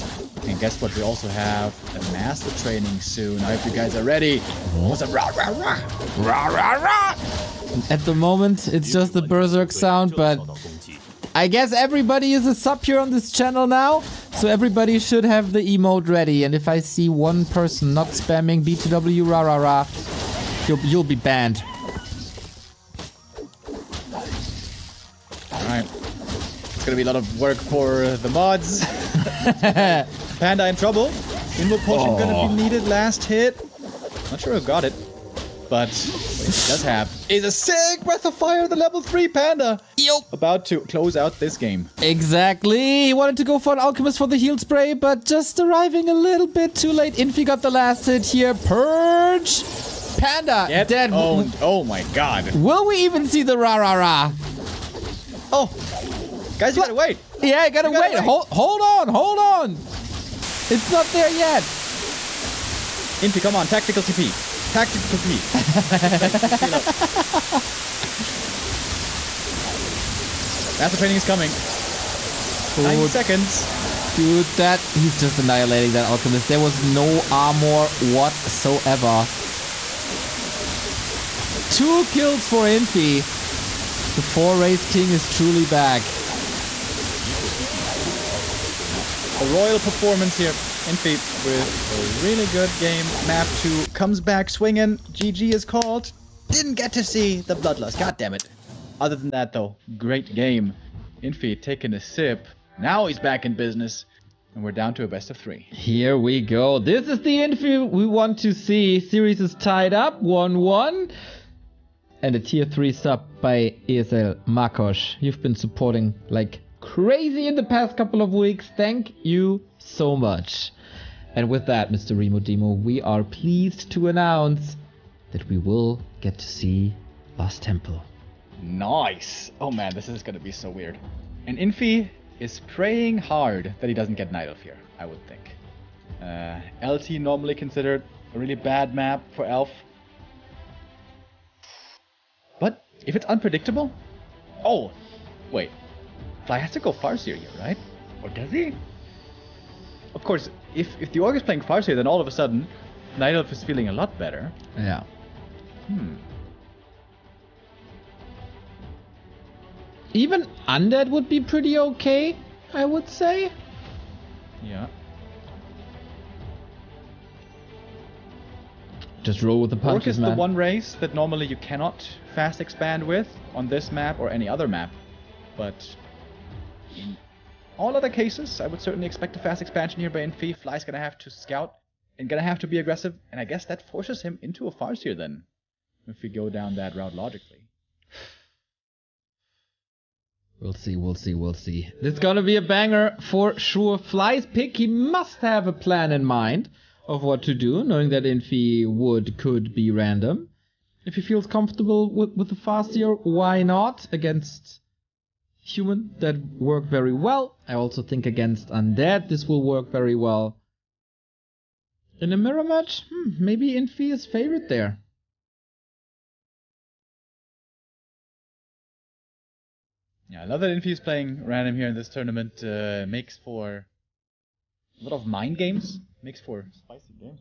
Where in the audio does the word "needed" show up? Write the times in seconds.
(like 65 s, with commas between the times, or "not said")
32 s.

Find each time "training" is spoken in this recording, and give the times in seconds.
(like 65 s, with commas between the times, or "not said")
2 s, 70 s.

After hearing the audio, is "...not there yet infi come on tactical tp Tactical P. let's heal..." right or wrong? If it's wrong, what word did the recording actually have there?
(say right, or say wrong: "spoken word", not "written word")
right.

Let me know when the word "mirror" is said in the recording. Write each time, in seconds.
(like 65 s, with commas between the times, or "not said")
212 s.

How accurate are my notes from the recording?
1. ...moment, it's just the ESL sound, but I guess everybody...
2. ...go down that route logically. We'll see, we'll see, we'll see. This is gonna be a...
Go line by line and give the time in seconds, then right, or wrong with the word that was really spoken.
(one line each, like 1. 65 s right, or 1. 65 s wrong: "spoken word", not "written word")
1. 8 s wrong: "Berserk", not "ESL"
2. 186 s right.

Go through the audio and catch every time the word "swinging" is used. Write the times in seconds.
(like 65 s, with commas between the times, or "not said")
94 s.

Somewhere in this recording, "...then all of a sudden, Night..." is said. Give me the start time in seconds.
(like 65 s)
151 s.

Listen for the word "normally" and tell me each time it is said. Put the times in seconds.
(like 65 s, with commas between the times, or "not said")
137 s, 171 s.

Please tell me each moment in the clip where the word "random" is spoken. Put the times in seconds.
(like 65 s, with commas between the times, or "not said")
199 s, 221 s.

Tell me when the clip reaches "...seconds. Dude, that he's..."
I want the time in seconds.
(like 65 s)
73 s.